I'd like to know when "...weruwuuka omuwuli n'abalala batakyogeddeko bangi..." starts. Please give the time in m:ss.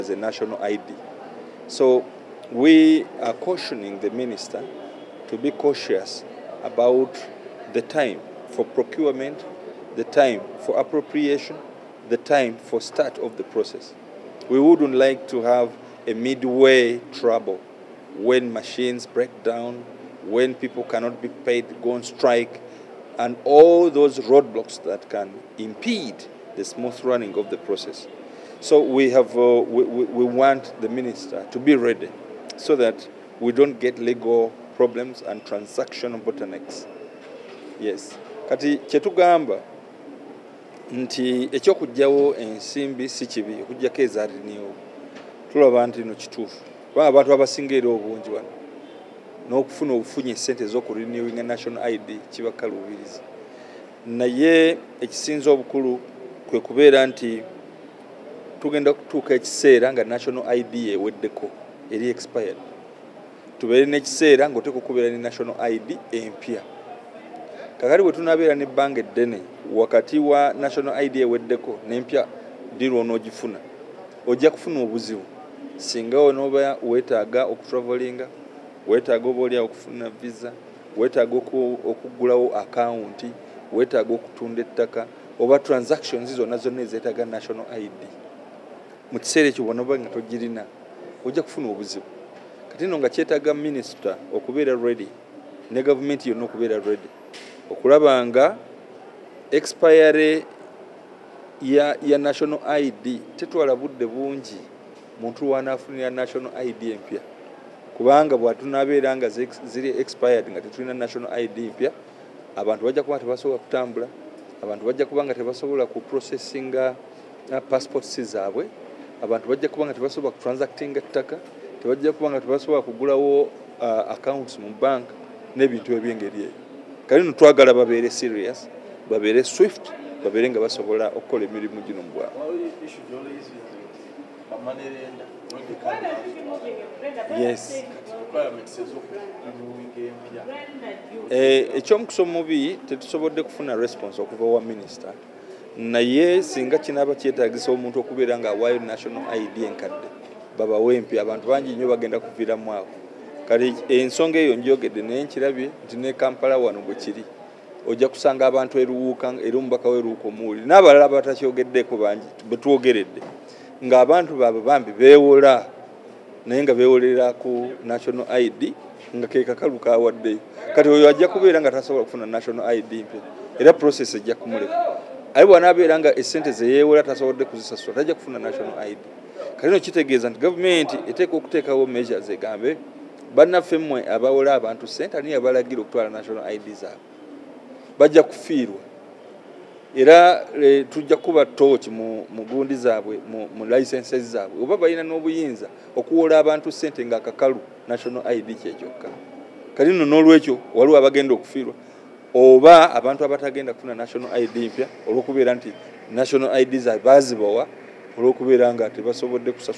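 2:39.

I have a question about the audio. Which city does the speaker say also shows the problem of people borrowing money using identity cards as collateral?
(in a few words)
Kampala.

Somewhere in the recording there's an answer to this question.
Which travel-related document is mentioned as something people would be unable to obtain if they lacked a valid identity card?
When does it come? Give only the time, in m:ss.
1:20.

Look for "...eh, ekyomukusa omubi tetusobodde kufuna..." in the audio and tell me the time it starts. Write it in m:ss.
2:21.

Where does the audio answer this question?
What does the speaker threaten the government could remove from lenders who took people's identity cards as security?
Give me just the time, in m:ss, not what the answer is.
3:13.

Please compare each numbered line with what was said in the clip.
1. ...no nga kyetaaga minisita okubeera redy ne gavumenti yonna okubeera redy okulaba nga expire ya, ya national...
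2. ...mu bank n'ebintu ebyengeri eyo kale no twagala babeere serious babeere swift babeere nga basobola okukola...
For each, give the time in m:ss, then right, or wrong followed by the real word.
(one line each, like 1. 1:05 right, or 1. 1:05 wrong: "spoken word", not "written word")
1. 1:32 right
2. 2:04 right.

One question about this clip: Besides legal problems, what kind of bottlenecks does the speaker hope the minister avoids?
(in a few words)
transaction bottlenecks.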